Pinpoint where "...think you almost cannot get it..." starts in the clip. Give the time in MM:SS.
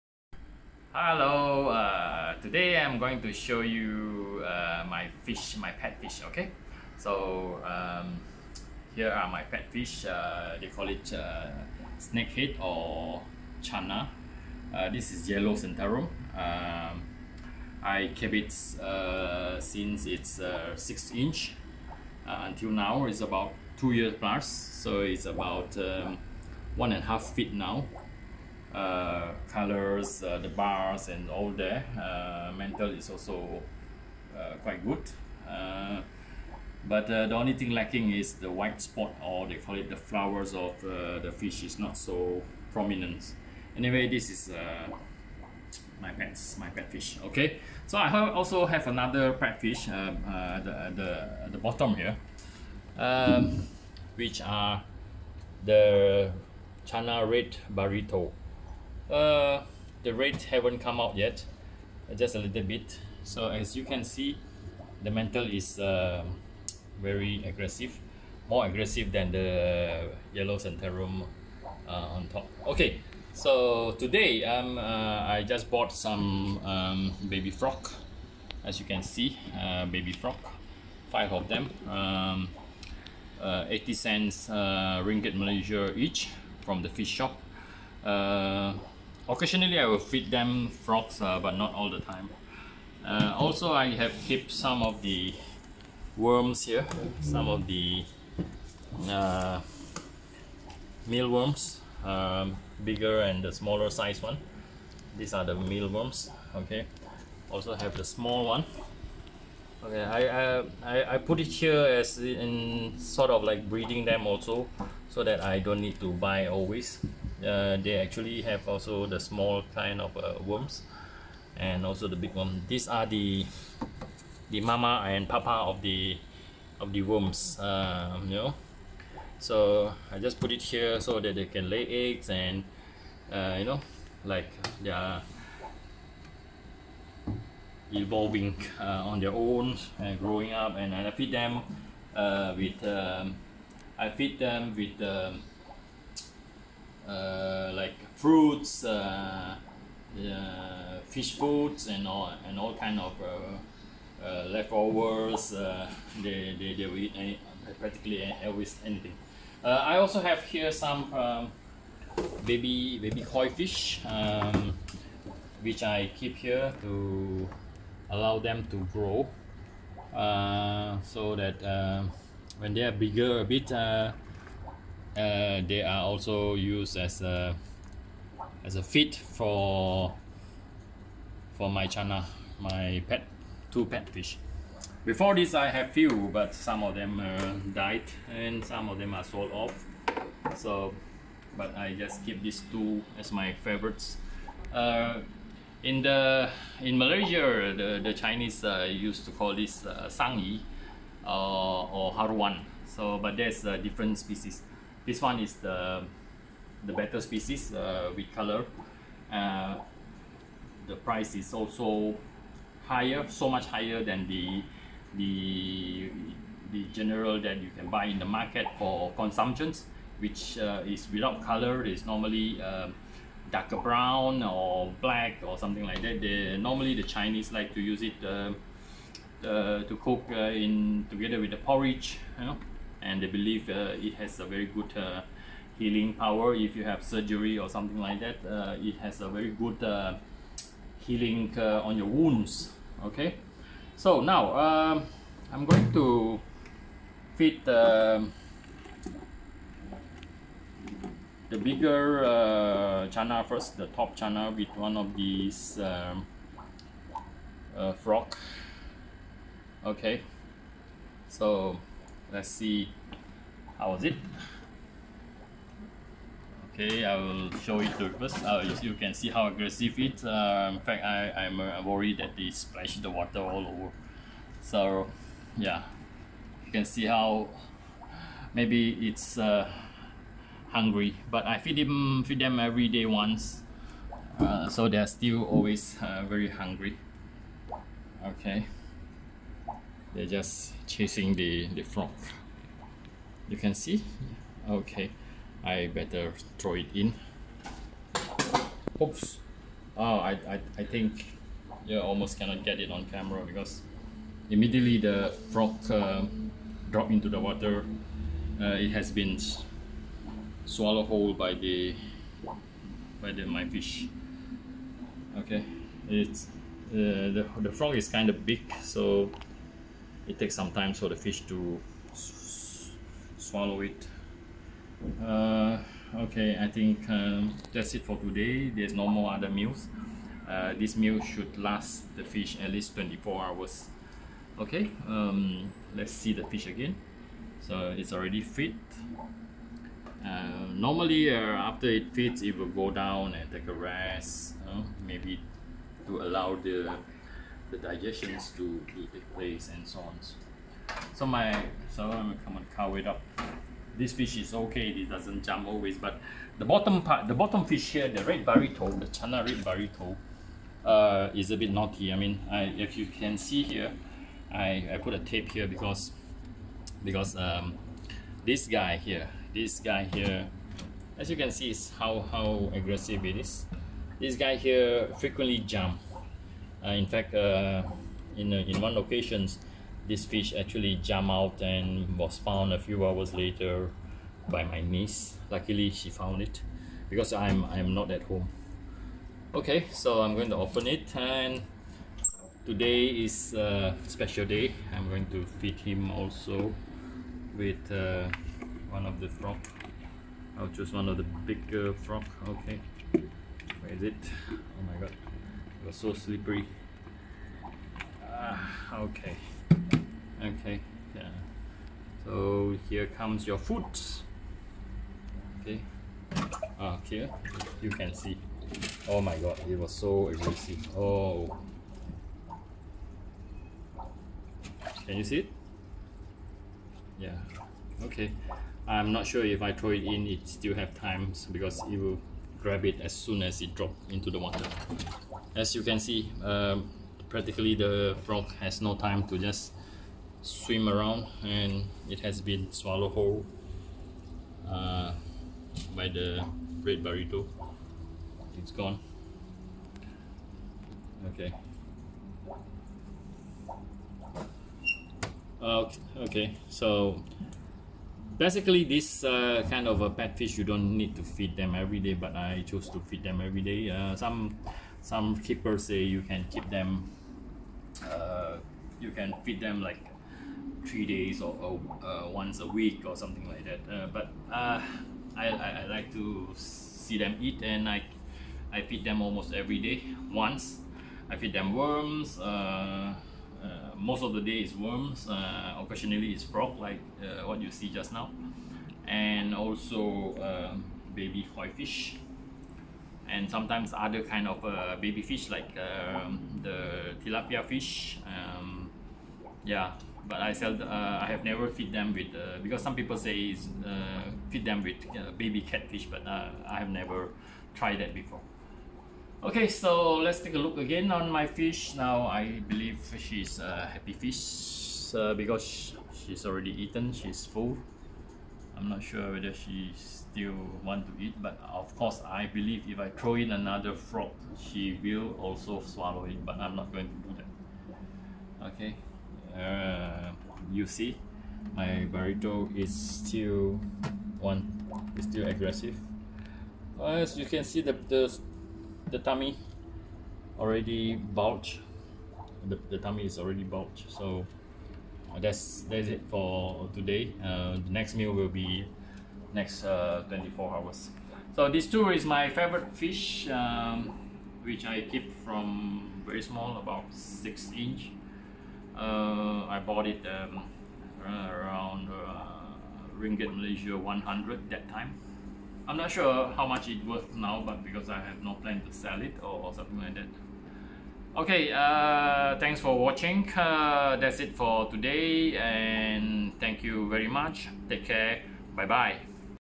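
05:00.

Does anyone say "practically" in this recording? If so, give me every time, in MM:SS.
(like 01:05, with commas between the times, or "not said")
02:37, 07:17.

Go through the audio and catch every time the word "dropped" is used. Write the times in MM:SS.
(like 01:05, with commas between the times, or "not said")
05:06, 07:13.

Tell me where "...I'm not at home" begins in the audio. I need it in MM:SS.
06:27.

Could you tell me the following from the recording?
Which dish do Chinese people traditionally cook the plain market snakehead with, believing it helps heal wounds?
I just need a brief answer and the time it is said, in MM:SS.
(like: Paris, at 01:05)
Porridge, at 03:51.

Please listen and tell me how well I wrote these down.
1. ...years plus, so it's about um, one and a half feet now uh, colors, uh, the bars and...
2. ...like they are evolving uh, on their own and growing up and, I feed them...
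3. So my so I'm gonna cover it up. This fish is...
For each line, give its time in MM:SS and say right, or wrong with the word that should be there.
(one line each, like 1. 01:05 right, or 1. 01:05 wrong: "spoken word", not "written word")
1. 00:23 right
2. 02:14 right
3. 05:51 right.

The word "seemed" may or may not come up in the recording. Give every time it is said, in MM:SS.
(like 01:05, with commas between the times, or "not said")
not said.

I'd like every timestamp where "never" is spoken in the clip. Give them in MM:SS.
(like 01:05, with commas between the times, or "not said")
08:21, 08:26.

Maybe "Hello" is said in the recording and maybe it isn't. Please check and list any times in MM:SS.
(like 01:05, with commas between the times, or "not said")
00:00.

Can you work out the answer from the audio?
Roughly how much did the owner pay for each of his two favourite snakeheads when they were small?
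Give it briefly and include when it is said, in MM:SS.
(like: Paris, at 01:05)
RM100, at 09:23.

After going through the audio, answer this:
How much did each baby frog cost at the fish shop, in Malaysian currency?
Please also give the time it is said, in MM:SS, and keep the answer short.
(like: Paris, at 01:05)
80 cents, at 01:23.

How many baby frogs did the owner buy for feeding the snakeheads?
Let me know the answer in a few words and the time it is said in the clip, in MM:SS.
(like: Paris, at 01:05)
5, at 01:21.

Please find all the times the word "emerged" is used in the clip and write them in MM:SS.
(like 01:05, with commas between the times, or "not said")
not said.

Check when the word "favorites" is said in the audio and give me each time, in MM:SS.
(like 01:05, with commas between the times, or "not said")
03:13, 09:12.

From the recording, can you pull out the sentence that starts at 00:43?
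Anyway, this is my pets, my pet fish.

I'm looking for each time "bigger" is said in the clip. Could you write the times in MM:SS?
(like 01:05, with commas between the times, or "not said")
01:42, 02:52, 04:11, 06:41.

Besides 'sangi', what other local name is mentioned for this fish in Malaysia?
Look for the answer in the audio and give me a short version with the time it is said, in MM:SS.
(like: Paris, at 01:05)
Haruan, at 03:22.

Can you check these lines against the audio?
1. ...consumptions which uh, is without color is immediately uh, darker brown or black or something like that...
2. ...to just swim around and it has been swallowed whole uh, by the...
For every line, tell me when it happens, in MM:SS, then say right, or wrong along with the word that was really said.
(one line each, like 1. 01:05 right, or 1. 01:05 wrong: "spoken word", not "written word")
1. 03:39 wrong: "normally", not "immediately"
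2. 07:19 right.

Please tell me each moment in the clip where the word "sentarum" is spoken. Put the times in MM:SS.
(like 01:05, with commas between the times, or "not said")
00:15, 01:10.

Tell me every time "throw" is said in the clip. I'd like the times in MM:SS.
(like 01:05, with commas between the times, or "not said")
04:56, 07:09, 08:43.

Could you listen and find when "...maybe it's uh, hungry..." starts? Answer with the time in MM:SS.
04:38.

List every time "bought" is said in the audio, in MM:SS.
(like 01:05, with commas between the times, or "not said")
01:15, 09:19.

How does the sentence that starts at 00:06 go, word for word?
So, um, here are my pet fish, uh, they call it uh, snakehead or channa.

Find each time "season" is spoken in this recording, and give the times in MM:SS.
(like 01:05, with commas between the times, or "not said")
not said.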